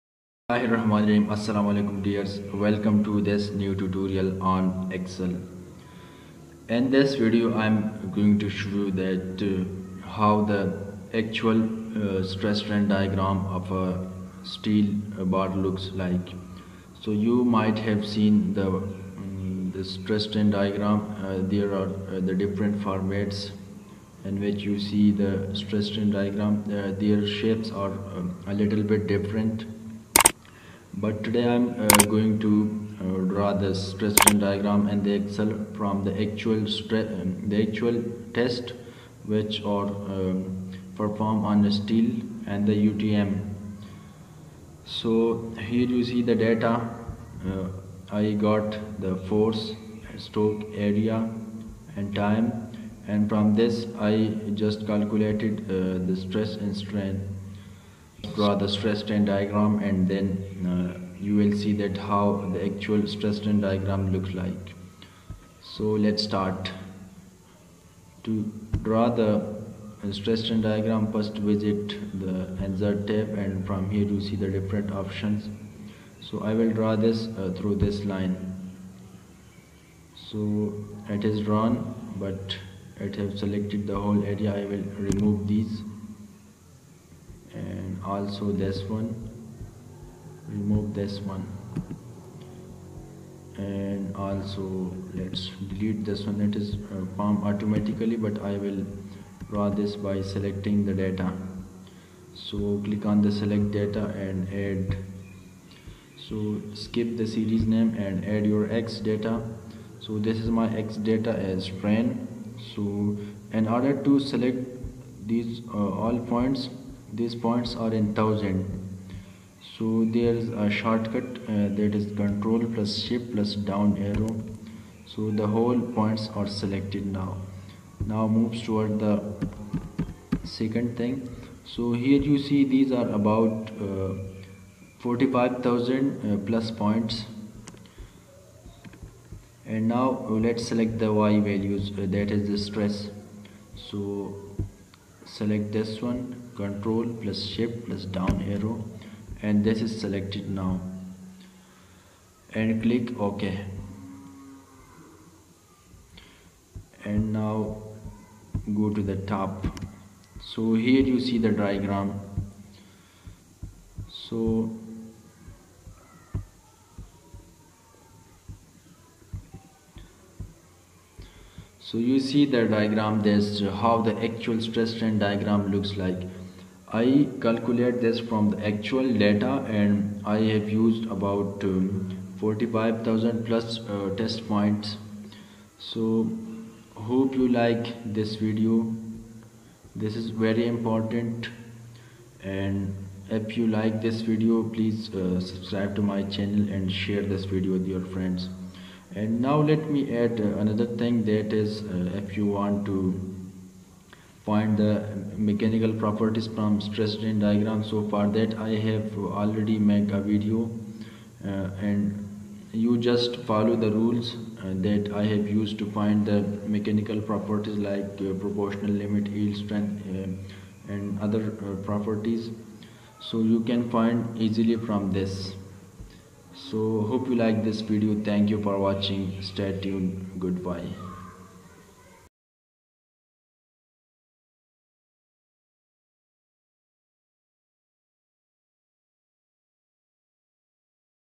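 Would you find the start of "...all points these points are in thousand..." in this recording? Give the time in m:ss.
1:55.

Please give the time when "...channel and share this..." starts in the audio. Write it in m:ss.
3:16.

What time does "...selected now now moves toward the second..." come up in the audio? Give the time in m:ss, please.
2:06.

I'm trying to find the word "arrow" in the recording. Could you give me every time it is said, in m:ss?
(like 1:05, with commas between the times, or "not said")
2:04, 2:28.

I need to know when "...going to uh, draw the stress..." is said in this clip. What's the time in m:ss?
0:32.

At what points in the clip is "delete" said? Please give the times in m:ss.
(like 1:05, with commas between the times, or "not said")
1:35.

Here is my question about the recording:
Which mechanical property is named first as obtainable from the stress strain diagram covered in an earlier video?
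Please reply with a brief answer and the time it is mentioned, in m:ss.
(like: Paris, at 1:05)
Proportional limit, at 3:38.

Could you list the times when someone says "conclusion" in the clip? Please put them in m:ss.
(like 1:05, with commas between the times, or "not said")
not said.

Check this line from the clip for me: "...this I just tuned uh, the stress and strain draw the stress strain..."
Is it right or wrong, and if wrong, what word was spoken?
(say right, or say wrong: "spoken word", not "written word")
wrong: "calculated", not "tuned".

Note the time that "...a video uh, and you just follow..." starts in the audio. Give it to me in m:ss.
3:30.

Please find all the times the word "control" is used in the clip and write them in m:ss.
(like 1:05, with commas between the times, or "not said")
2:02, 2:26.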